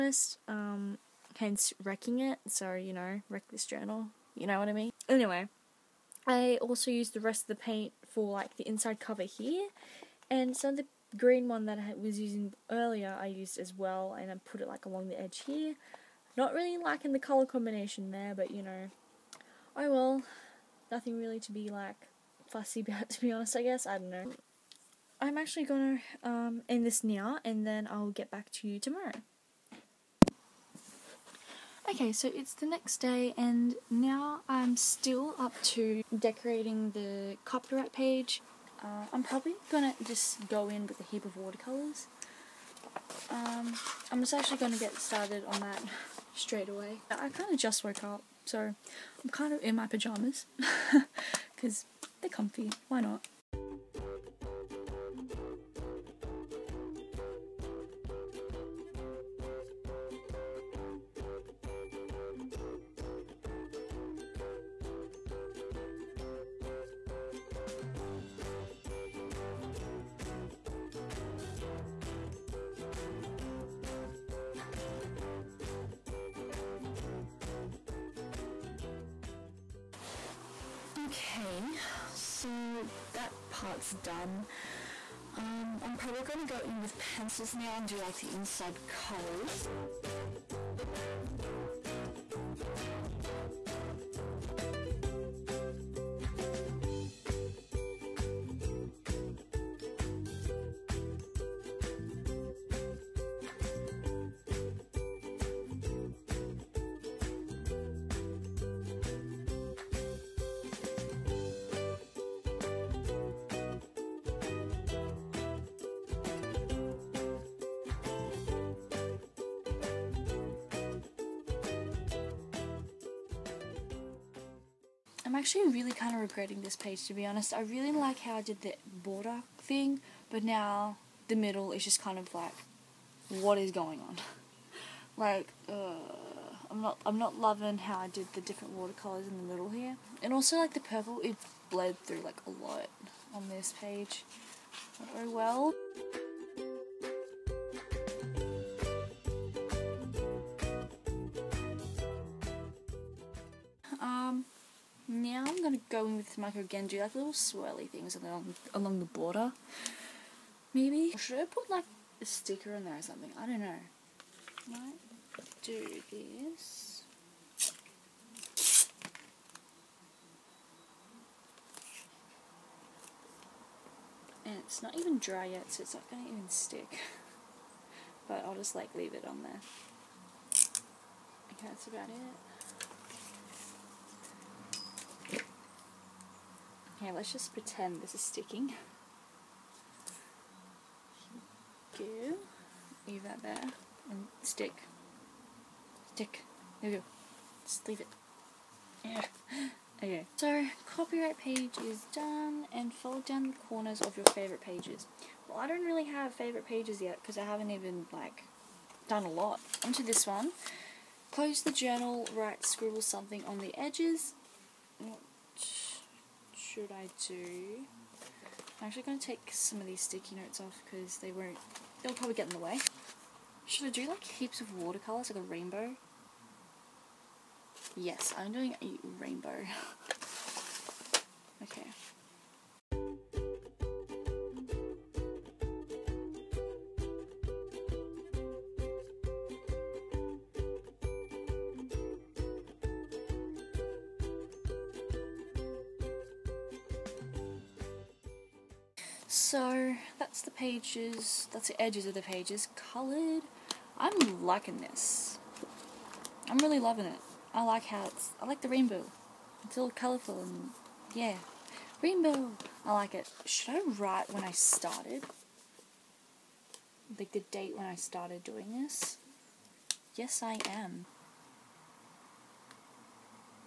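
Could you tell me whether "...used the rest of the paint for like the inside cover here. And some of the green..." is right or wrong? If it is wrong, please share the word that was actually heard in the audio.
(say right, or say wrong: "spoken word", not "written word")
right.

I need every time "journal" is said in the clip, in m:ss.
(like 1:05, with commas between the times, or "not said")
0:03, 3:31.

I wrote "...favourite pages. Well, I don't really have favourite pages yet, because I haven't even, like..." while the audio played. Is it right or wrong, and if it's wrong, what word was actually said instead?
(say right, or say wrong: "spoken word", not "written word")
right.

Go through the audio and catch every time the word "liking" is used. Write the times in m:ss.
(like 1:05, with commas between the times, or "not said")
0:16, 4:14.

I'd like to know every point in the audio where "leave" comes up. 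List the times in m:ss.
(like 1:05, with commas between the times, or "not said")
2:58, 3:13, 3:17.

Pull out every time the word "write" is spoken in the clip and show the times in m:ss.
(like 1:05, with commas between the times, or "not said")
3:32, 4:23.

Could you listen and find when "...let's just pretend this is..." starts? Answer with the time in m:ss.
3:07.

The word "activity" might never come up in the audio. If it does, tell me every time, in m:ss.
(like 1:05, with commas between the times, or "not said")
not said.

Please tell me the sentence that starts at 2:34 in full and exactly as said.
Um, now I'm going to go in with mica again, do like little swirly things along, along the border.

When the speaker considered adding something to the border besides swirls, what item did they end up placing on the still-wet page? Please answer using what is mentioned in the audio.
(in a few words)
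A sticker.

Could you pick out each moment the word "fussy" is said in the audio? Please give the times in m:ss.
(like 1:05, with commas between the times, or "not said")
0:22.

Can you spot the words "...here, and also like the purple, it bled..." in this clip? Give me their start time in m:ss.
2:19.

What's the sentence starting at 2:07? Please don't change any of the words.
I really like how I did the border thing, but now the middle is just kind of like, what is going on?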